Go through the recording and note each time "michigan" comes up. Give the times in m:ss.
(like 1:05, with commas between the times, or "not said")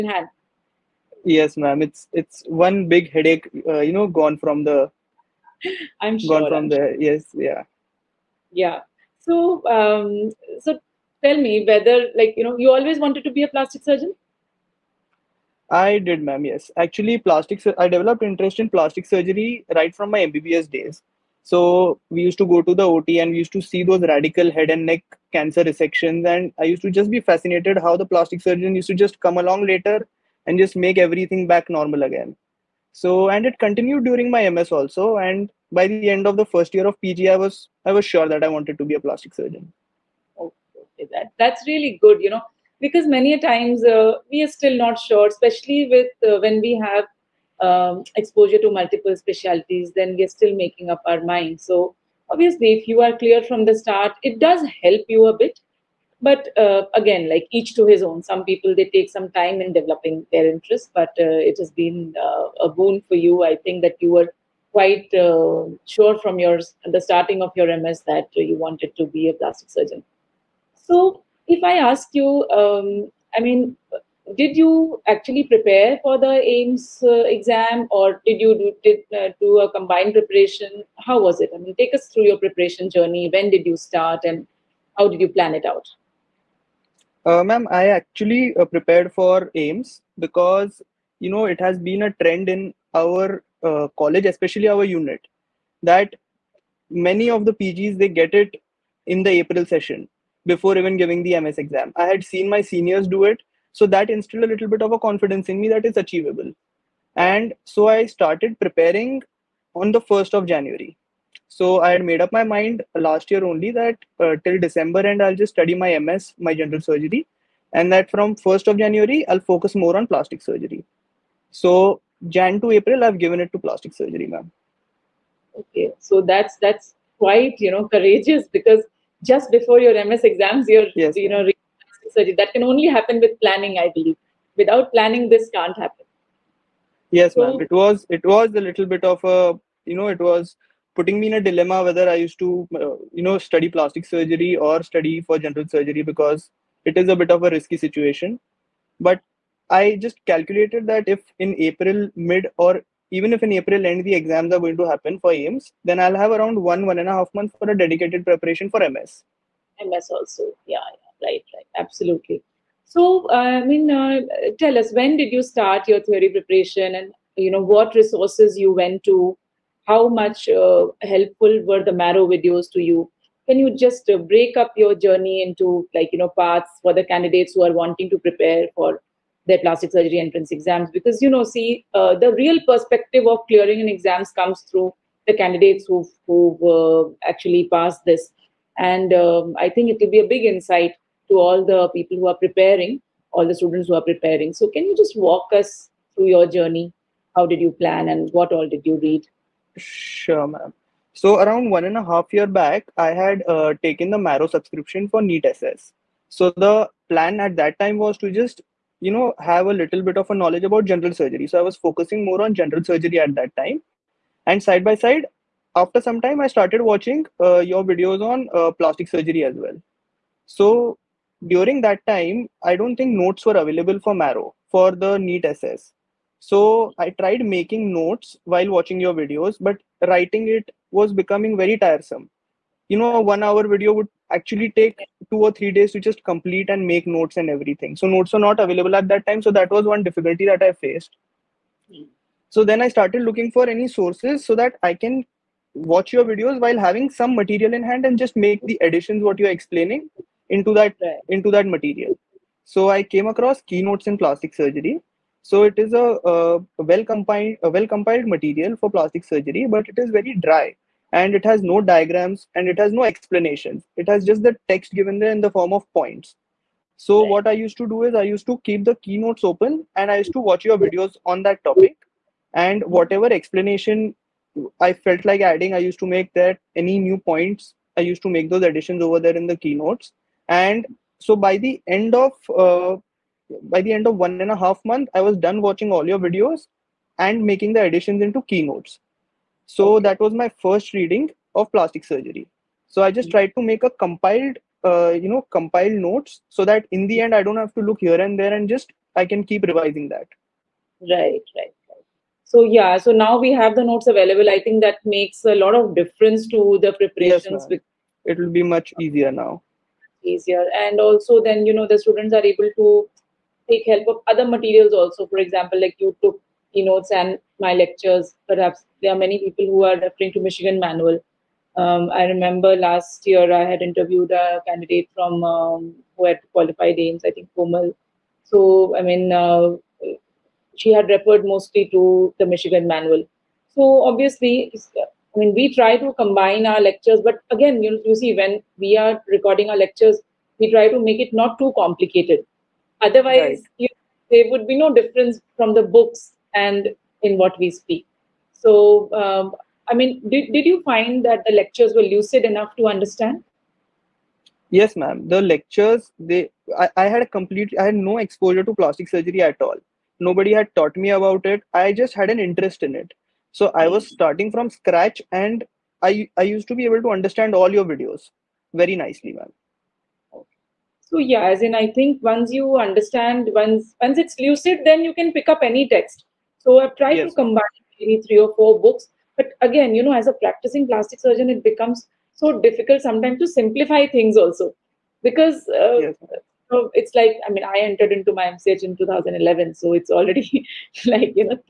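5:20, 5:32.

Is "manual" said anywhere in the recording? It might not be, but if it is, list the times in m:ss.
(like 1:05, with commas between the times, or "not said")
5:20, 5:32.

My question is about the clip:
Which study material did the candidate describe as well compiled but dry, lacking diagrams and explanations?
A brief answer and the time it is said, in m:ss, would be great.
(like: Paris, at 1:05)
Keynotes in Plastic Surgery, at 4:13.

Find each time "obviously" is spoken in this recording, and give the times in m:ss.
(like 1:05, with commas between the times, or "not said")
0:52, 5:34.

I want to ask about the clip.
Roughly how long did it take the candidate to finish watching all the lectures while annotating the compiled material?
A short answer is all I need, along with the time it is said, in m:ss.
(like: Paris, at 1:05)
1.5 months, at 4:44.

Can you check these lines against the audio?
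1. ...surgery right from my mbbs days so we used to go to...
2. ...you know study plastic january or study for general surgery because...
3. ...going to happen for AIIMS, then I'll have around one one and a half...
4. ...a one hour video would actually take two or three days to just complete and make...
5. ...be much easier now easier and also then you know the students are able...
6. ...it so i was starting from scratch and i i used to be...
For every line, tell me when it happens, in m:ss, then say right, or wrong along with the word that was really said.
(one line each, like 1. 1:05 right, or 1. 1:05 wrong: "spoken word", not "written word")
1. 0:19 right
2. 2:23 wrong: "surgery", not "january"
3. 2:34 right
4. 3:53 right
5. 5:08 right
6. 6:02 right.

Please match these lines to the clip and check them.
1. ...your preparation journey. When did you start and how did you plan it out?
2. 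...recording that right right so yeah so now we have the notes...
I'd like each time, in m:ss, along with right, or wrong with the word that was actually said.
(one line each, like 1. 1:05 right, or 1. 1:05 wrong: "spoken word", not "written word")
1. 1:22 right
2. 4:59 wrong: "revising", not "recording".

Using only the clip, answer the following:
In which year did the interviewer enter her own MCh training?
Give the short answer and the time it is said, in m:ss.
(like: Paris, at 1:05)
2011, at 6:28.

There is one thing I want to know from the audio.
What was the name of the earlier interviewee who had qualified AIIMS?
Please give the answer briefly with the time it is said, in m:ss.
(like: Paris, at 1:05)
Komal, at 5:27.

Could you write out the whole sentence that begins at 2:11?
you know that can only happen with planning, I believe.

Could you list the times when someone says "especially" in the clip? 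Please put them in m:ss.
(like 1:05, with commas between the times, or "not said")
0:45, 1:34.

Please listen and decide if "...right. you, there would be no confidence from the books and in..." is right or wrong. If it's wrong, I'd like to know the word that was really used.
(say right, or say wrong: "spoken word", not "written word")
wrong: "difference", not "confidence".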